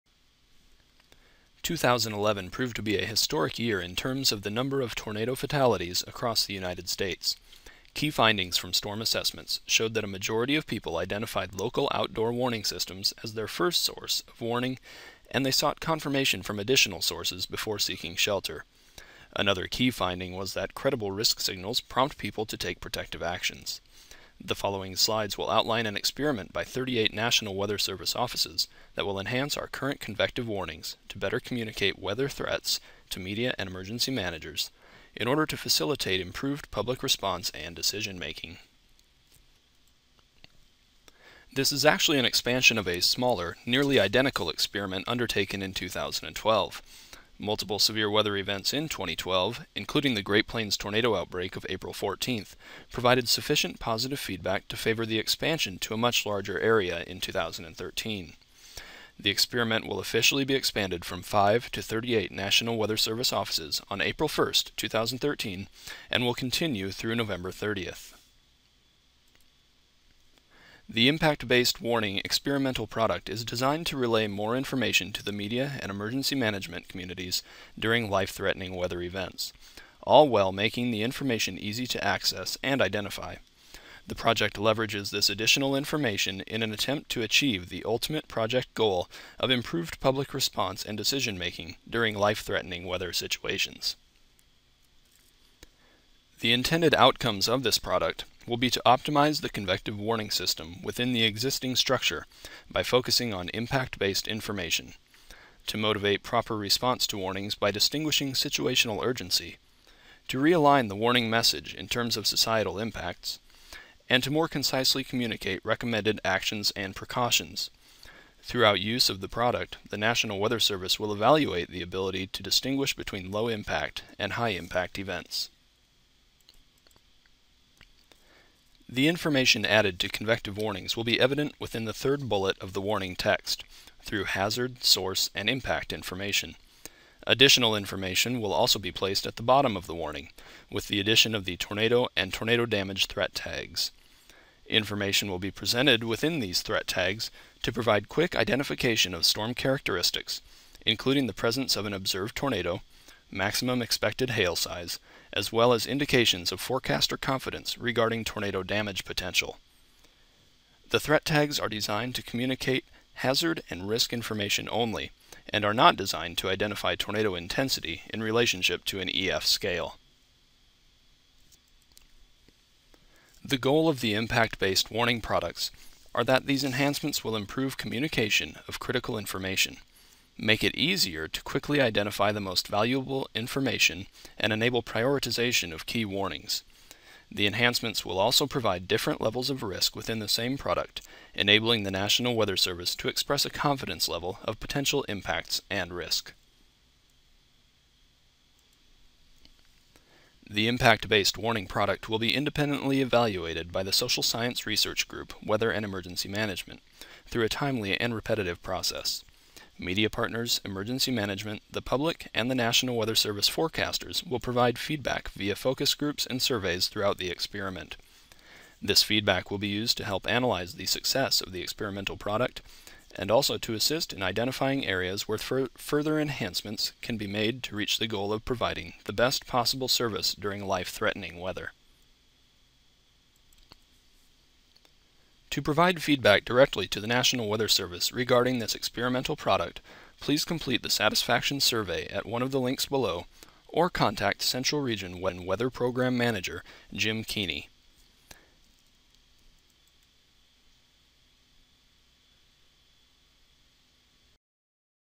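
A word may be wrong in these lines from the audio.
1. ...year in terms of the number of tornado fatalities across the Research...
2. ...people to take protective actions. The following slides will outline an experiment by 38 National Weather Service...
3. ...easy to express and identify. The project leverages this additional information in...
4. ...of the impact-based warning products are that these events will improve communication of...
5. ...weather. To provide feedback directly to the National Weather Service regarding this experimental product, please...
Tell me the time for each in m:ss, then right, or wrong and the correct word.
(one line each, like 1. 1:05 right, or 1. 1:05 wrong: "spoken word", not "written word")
1. 0:03 wrong: "United", not "Research"
2. 0:22 right
3. 1:21 wrong: "access", not "express"
4. 2:53 wrong: "enhancements", not "events"
5. 3:51 right.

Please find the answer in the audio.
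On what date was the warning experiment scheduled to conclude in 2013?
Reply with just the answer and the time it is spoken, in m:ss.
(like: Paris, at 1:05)
November 30th, at 1:07.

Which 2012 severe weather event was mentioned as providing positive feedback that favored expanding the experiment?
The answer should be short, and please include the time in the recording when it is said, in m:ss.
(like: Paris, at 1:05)
Great Plains tornado outbreak, at 0:50.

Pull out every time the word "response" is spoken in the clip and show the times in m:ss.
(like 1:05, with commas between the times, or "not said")
0:37, 1:30, 1:46.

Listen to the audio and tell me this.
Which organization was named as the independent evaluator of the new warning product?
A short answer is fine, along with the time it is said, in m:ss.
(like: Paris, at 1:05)
Social Science Research Group, at 3:23.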